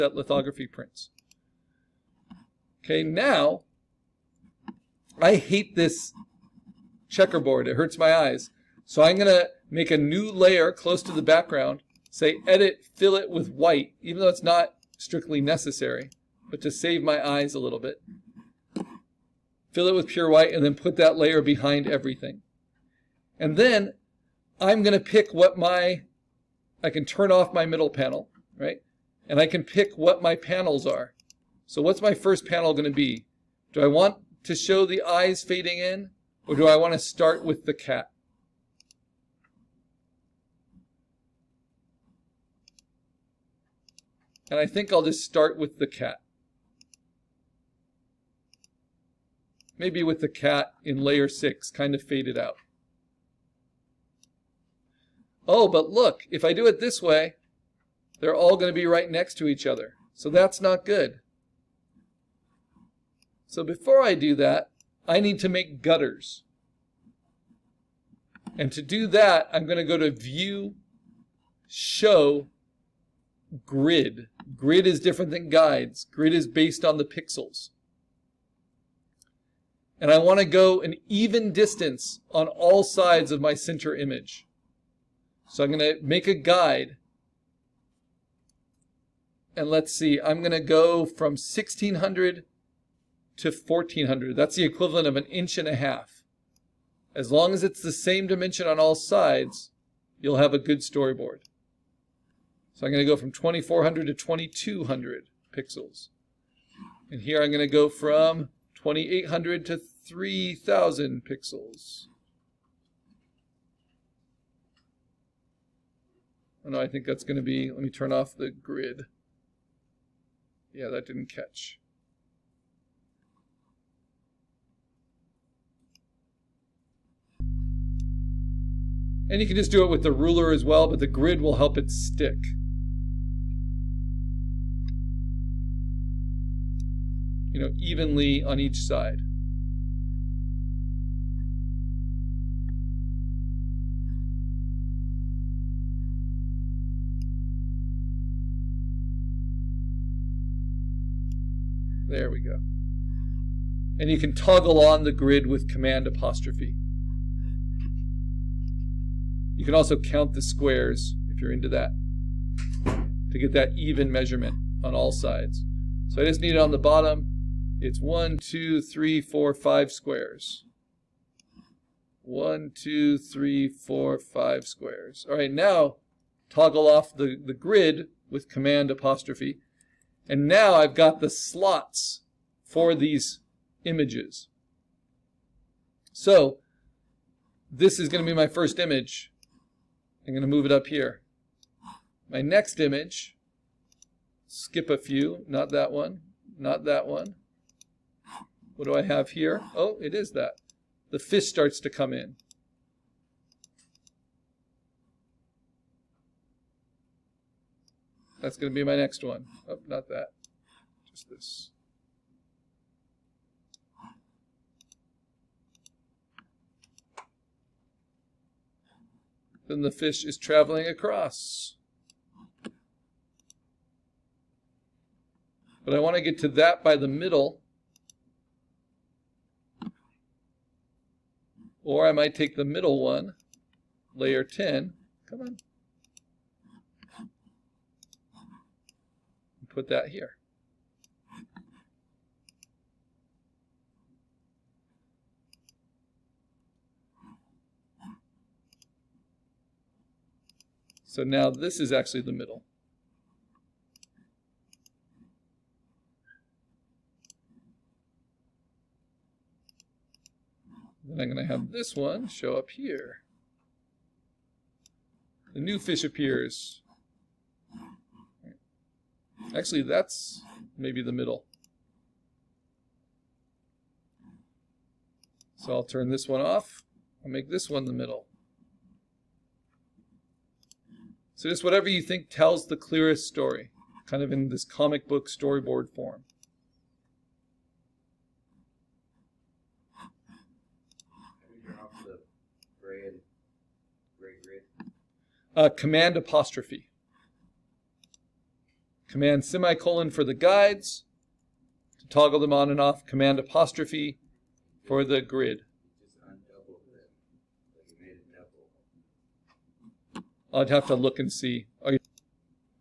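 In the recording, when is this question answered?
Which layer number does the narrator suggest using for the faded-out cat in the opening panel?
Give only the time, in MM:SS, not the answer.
00:51.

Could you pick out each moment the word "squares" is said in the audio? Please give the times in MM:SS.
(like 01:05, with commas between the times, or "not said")
02:40, 02:49, 02:54.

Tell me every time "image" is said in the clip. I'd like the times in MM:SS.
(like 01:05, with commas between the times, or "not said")
01:23, 03:03, 03:08, 03:12.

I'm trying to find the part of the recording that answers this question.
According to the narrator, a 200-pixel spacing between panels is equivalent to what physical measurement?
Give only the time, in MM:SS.
01:35.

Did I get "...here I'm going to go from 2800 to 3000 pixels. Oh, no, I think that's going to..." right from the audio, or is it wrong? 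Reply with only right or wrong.
right.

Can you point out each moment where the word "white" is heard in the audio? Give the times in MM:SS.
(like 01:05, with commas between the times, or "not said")
00:13, 00:20.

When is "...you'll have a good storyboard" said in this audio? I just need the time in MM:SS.
01:40.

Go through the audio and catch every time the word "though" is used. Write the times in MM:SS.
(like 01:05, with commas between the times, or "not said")
00:14.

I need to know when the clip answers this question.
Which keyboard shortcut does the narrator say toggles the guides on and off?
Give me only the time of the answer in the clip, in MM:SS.
04:59.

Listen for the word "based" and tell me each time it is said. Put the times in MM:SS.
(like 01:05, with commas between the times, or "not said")
01:16.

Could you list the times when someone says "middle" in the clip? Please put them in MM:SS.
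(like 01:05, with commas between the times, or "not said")
00:27, 03:47, 03:52, 04:12, 04:31, 04:37.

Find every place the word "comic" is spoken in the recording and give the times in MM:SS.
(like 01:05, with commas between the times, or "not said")
04:44.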